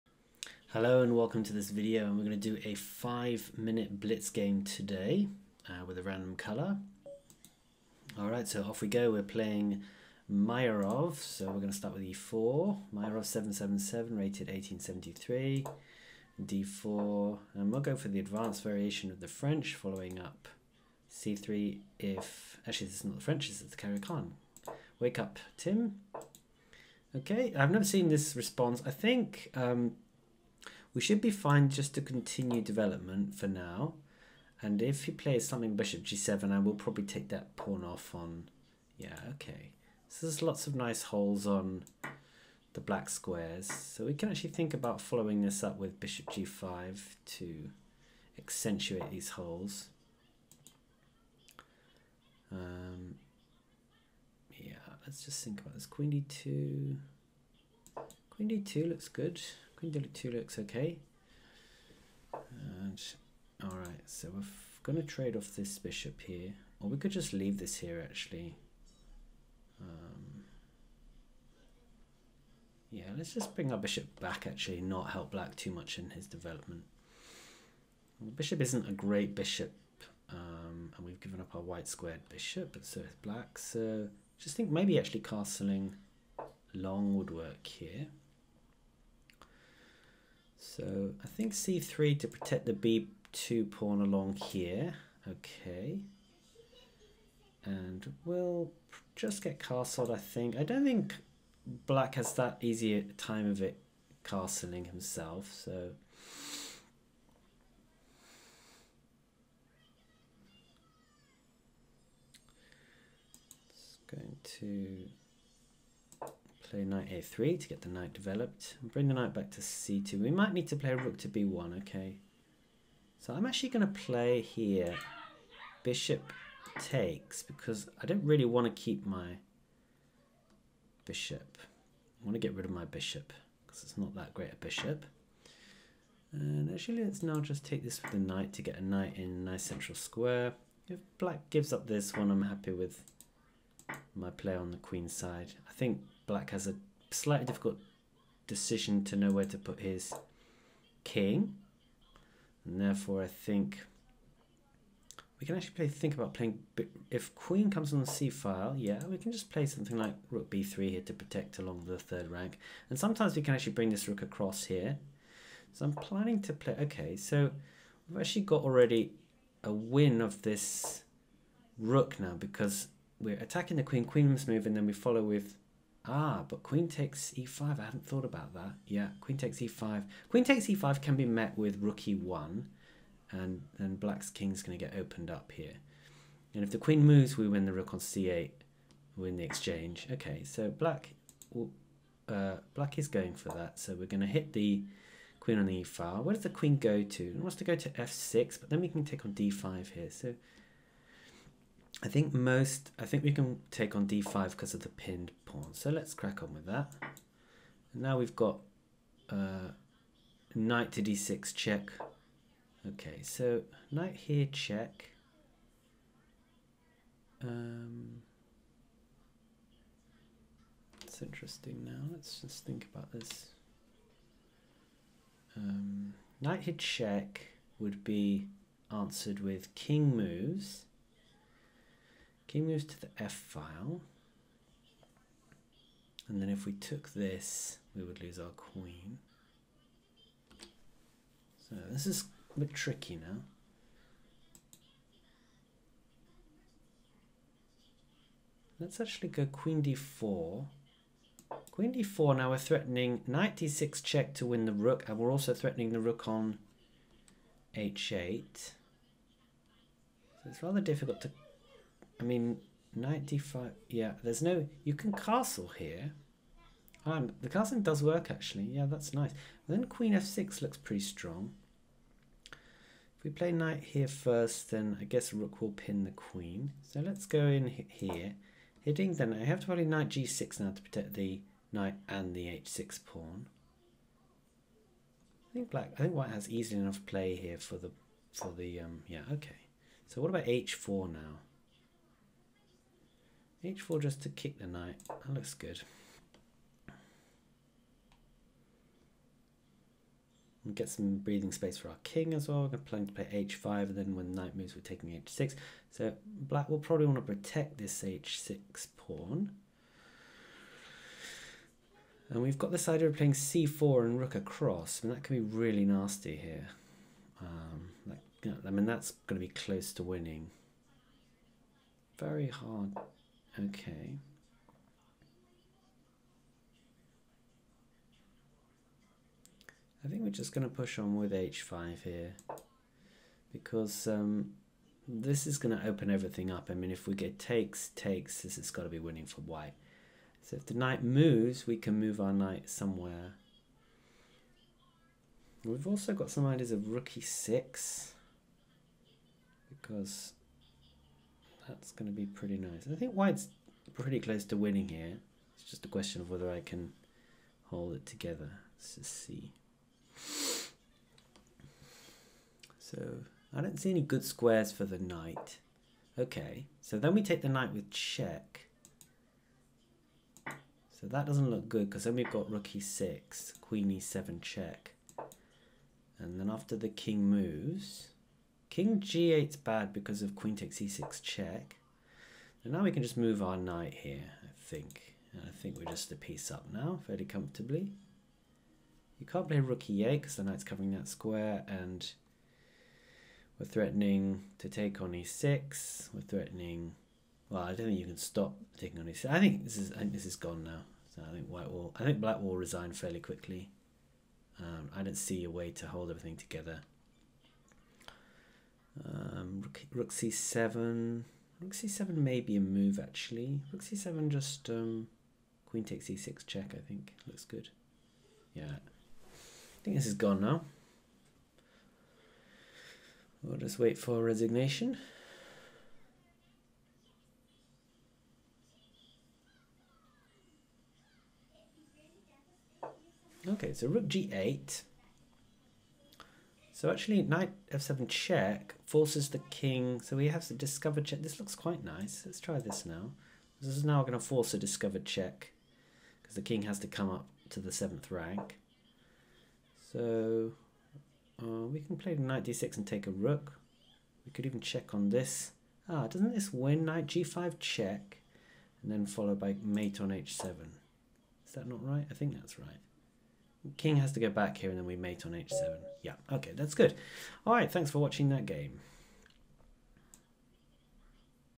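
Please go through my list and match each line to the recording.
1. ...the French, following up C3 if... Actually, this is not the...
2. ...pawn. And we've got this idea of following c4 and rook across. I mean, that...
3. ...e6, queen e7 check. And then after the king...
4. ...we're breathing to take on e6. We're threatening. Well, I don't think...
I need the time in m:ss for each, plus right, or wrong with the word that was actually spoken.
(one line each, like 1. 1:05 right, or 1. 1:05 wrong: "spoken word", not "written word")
1. 0:19 right
2. 5:08 wrong: "playing", not "following"
3. 6:12 right
4. 6:33 wrong: "threatening", not "breathing".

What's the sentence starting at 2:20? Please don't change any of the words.
If black gives up this one, I'm happy with my play on the queen side.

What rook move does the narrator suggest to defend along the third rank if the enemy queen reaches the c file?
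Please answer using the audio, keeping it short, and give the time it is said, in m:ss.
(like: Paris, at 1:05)
Rook b3, at 2:40.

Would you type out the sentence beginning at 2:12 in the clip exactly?
I want to get rid of my bishop because it's not that great a bishop.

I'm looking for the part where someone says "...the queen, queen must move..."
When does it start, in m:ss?
2:53.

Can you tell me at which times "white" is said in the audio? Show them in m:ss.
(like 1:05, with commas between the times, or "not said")
1:21, 4:46, 5:39, 5:53, 6:41.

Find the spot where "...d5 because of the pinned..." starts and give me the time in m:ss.
3:24.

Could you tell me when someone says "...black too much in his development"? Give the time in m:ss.
1:15.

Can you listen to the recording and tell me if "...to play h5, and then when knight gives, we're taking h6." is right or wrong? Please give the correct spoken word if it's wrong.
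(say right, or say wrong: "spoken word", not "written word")
wrong: "moves", not "gives".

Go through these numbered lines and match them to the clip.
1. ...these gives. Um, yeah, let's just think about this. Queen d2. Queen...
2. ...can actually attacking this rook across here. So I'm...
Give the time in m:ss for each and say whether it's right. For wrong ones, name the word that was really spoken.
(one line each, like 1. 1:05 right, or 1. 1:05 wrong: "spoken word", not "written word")
1. 0:49 wrong: "holes", not "gives"
2. 2:43 wrong: "bring", not "attacking".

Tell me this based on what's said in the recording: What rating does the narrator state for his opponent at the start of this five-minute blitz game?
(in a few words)
1873.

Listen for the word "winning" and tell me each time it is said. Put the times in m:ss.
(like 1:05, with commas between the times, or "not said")
5:20, 5:38, 5:54.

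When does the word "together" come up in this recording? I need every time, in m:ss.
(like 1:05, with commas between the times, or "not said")
5:58, 6:46.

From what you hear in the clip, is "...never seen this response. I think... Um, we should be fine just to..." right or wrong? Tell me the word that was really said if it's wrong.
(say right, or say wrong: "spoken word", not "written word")
right.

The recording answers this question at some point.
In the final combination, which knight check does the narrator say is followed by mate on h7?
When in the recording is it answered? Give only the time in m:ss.
7:36.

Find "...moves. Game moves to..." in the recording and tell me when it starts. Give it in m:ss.
3:50.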